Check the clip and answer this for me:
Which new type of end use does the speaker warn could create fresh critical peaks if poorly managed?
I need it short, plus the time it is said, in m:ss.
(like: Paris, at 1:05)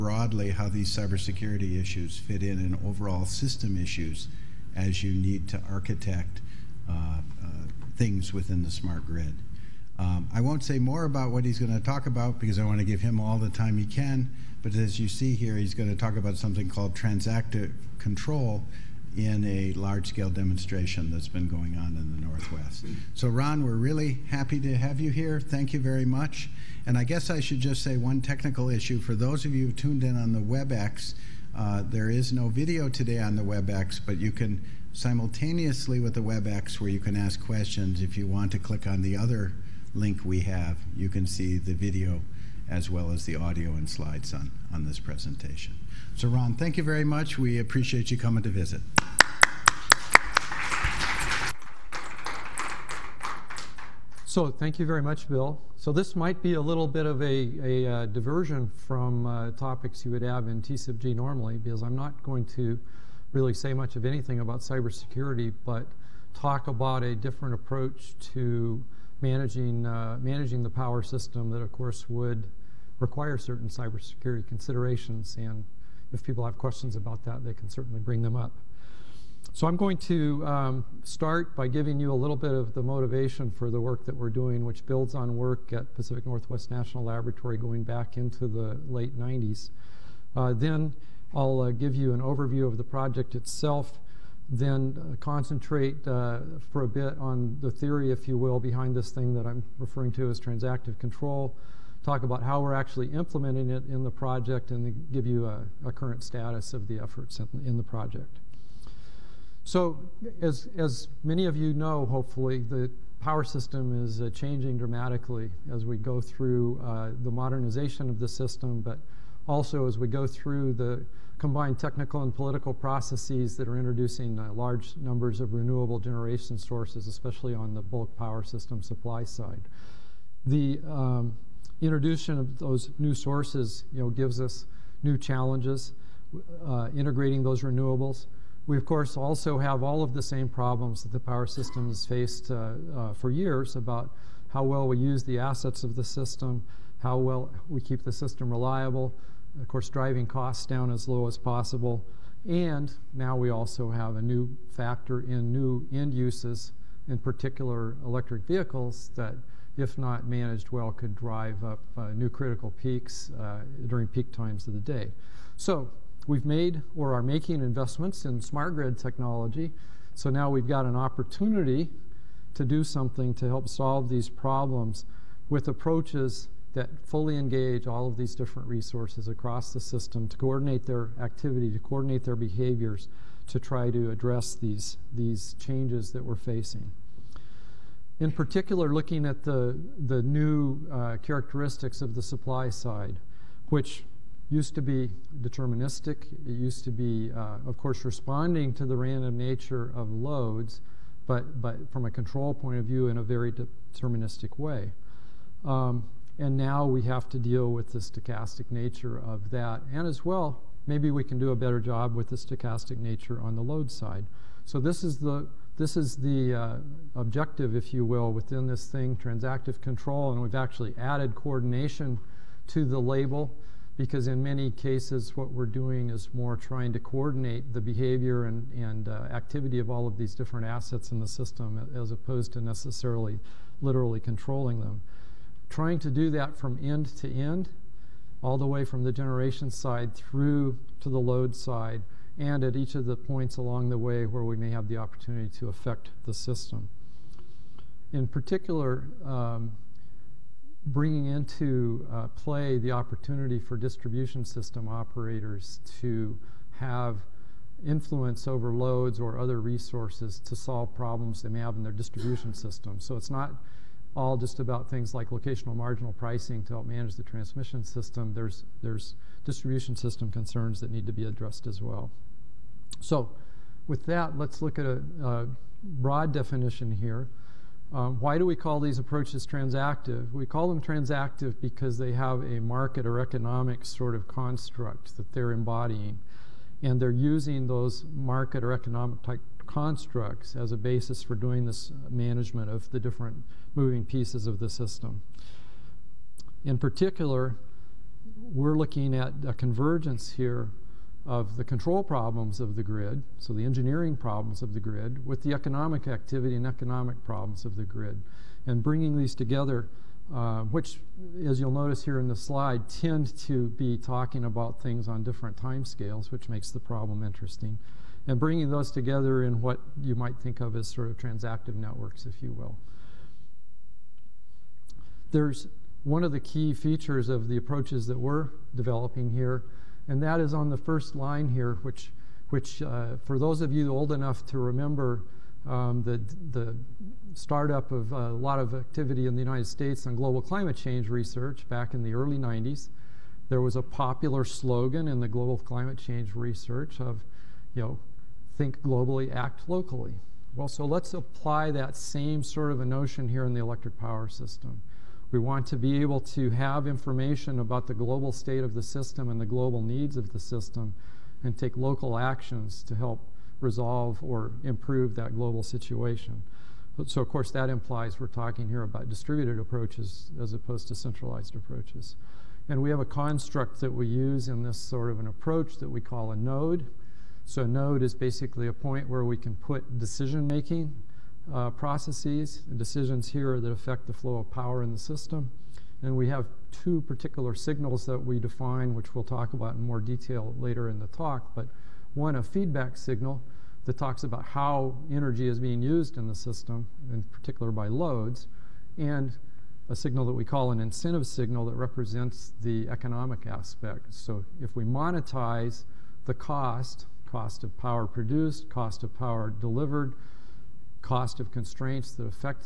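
electric vehicles, at 2:38.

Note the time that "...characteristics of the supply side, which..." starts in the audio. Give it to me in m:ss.
3:11.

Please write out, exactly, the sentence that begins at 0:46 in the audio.
So, Ron, thank you very much.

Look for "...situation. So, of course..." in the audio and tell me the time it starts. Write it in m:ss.
6:05.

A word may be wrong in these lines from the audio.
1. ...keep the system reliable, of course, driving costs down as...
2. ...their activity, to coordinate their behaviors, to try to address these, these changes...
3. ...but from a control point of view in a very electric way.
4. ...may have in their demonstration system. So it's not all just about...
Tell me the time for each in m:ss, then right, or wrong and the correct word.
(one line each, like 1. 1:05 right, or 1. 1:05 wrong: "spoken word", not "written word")
1. 2:27 right
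2. 3:00 right
3. 3:21 wrong: "deterministic", not "electric"
4. 4:21 wrong: "distribution", not "demonstration".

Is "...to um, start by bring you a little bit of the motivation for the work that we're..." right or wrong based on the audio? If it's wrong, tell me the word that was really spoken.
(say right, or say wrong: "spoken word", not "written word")
wrong: "giving", not "bring".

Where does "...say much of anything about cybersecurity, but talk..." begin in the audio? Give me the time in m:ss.
1:03.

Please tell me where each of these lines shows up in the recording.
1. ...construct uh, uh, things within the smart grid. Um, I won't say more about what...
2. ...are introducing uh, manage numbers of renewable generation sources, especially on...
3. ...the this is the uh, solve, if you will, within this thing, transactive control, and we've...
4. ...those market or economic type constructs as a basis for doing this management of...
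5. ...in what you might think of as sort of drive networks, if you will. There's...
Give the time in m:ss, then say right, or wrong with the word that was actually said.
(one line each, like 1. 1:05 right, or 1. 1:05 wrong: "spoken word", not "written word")
1. 0:05 wrong: "architect", not "construct"
2. 2:03 wrong: "large", not "manage"
3. 3:35 wrong: "objective", not "solve"
4. 4:47 right
5. 5:19 wrong: "transactive", not "drive".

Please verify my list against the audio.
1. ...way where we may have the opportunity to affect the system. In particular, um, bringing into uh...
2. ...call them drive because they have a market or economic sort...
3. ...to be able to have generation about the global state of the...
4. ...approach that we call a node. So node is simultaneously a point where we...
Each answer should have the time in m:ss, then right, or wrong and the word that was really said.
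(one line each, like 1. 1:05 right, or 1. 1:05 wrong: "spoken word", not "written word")
1. 4:03 right
2. 4:40 wrong: "transactive", not "drive"
3. 5:55 wrong: "information", not "generation"
4. 6:15 wrong: "basically", not "simultaneously".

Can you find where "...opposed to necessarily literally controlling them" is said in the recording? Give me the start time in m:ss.
3:52.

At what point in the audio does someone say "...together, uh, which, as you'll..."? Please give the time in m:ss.
5:09.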